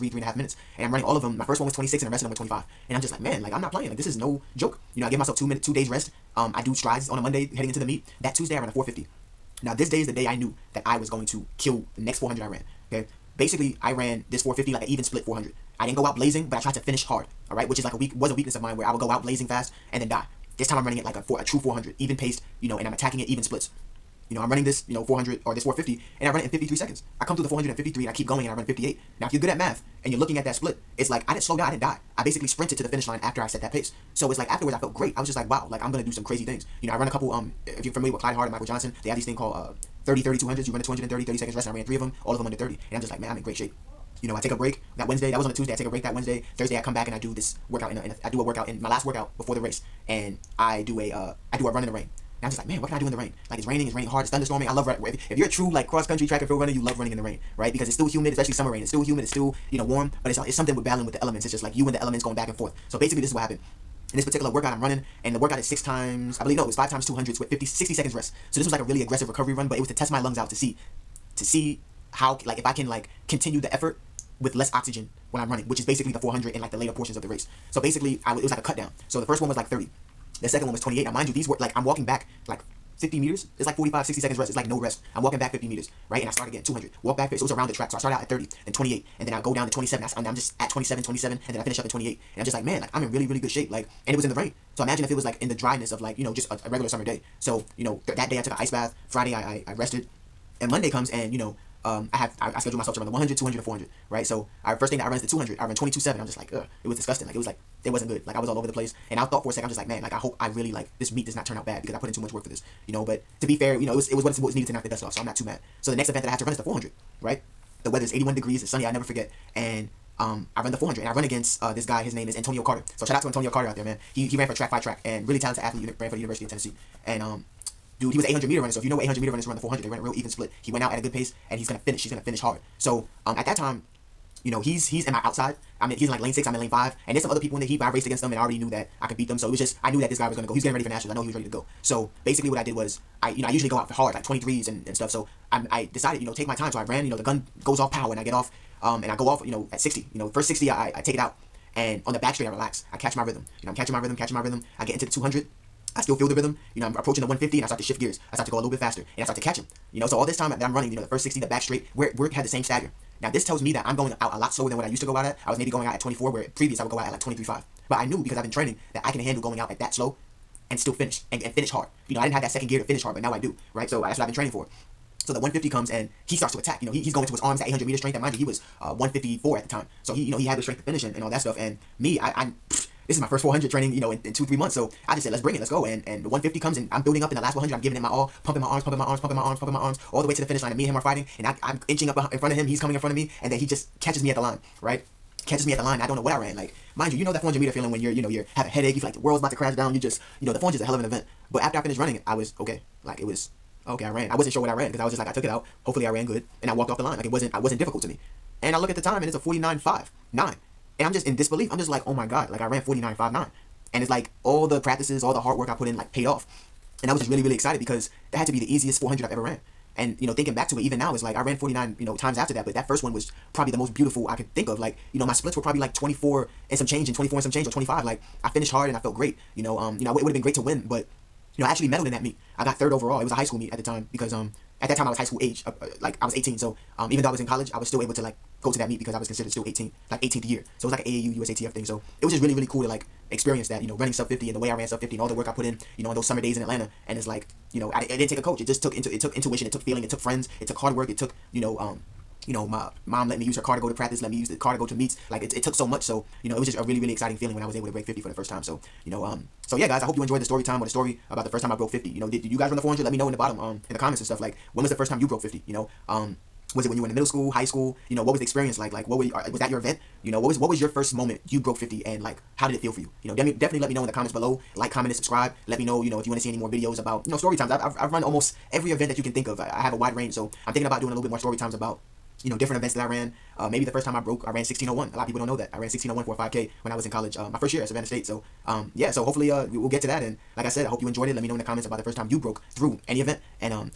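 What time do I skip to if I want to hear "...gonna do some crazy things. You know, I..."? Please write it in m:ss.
0:35.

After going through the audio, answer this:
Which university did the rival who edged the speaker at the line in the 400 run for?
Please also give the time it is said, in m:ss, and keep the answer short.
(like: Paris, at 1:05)
University of Tennessee, at 2:06.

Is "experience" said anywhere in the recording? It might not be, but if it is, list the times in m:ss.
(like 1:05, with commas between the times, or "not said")
4:03, 4:28.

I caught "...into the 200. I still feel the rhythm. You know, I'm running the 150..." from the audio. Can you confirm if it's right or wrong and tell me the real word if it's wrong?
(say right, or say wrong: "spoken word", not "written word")
wrong: "approaching", not "running".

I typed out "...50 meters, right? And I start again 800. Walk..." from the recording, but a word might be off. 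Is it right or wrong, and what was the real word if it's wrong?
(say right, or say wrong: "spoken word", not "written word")
wrong: "200", not "800".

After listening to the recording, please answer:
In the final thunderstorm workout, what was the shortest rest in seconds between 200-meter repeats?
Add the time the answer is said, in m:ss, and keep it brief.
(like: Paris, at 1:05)
50, at 1:07.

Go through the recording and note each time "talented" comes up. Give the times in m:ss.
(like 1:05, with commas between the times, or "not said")
2:05.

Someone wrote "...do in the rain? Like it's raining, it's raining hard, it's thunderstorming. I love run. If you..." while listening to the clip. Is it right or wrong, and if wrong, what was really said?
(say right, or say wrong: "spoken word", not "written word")
right.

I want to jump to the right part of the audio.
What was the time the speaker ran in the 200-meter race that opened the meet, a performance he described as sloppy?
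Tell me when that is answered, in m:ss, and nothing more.
1:45.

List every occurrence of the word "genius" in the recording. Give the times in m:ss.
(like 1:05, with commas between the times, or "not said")
not said.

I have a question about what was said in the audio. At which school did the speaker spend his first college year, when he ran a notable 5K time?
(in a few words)
Savannah State.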